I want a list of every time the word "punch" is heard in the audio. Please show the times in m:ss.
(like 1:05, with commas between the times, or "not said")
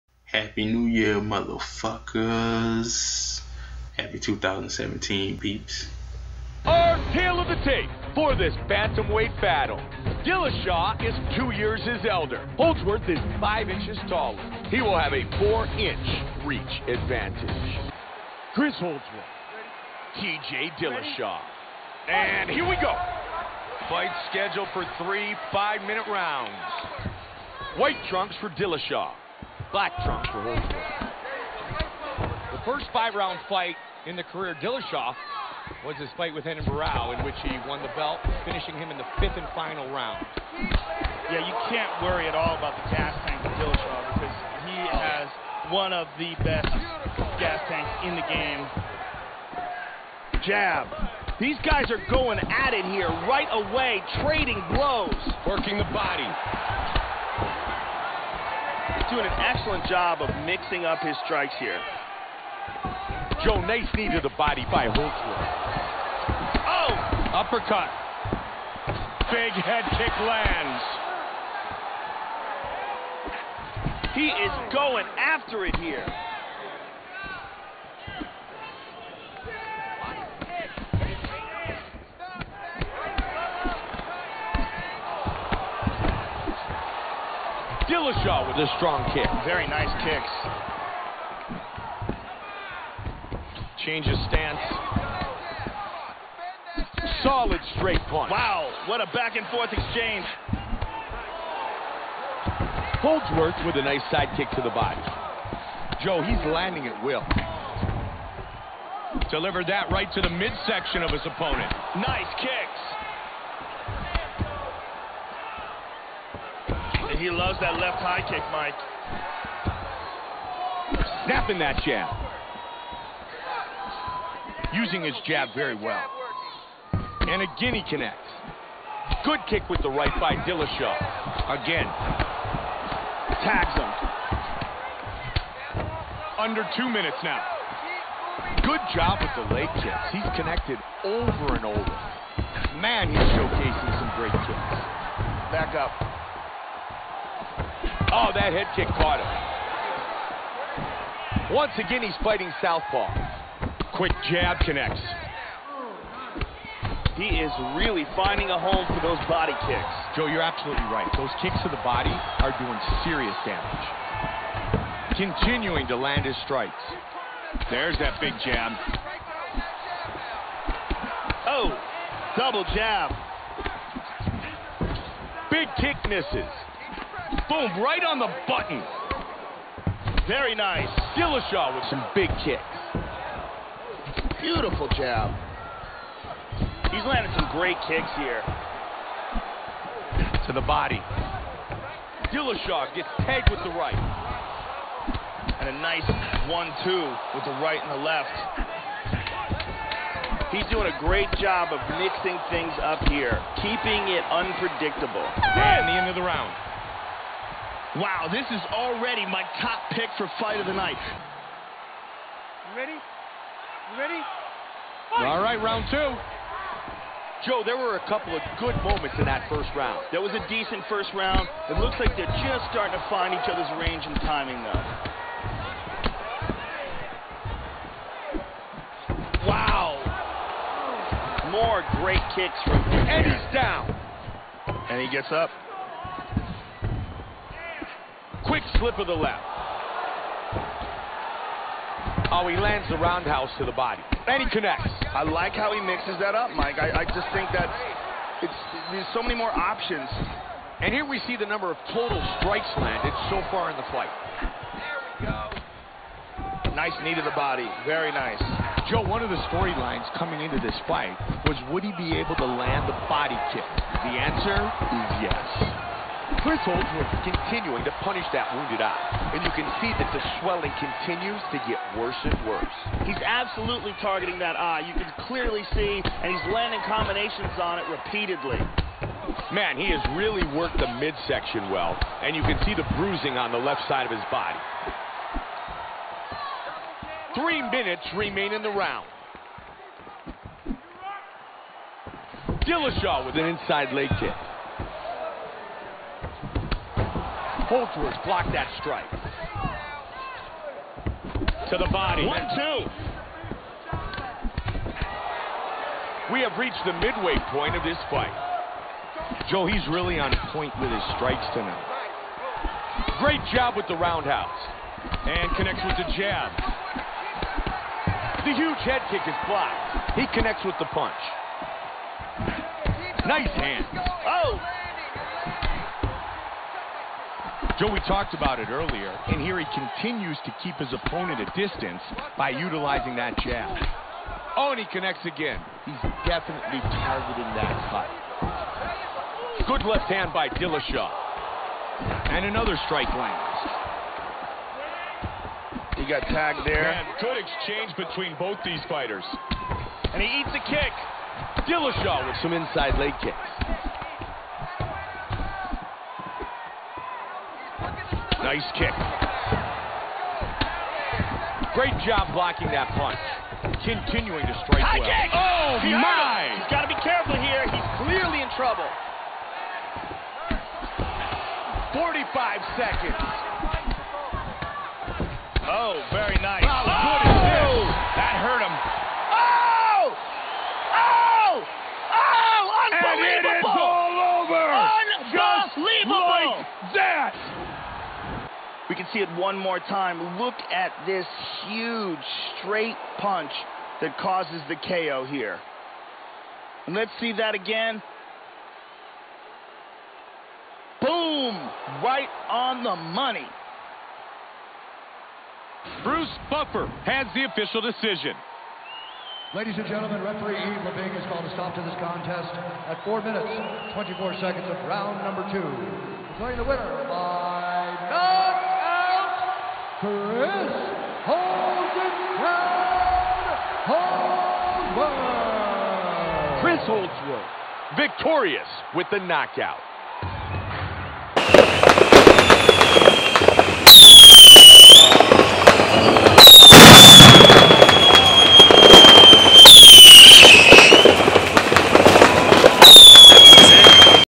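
1:38, 5:20, 6:02, 6:33.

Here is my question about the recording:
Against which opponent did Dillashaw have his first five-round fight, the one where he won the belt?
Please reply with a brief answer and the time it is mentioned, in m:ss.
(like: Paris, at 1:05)
Renan Barao, at 0:36.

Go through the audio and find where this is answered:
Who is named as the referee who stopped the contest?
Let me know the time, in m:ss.
6:50.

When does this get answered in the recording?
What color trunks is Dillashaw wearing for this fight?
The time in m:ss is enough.
0:27.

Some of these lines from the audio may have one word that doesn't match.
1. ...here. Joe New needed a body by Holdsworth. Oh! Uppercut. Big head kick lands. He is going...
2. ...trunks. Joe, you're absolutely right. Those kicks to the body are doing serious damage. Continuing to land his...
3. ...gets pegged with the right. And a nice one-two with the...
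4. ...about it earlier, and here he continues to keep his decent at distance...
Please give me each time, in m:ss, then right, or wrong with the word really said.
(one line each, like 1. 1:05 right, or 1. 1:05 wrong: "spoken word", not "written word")
1. 1:01 wrong: "Nace", not "New"
2. 2:39 wrong: "kicks", not "trunks"
3. 3:12 right
4. 5:28 wrong: "opponent", not "decent".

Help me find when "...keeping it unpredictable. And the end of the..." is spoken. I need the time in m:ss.
3:23.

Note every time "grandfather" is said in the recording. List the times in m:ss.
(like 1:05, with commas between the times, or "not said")
not said.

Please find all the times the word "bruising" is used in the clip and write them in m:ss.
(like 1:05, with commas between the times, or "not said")
4:42.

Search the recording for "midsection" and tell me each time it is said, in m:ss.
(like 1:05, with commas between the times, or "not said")
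1:50, 4:40.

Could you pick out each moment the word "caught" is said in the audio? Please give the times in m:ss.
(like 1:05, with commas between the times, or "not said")
2:28.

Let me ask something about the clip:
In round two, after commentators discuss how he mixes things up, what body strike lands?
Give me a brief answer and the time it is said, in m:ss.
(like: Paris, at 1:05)
Knee, at 4:17.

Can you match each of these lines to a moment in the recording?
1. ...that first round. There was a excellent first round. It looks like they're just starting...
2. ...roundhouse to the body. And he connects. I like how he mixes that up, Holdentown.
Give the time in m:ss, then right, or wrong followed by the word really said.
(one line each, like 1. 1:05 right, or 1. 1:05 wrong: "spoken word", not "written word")
1. 3:39 wrong: "decent", not "excellent"
2. 4:02 wrong: "Mike", not "Holdentown".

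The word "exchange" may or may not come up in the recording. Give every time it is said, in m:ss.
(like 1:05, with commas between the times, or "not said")
1:39, 5:47.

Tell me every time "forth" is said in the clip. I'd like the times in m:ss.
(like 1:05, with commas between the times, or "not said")
1:39.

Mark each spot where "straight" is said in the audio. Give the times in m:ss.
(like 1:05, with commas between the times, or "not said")
1:37, 6:32.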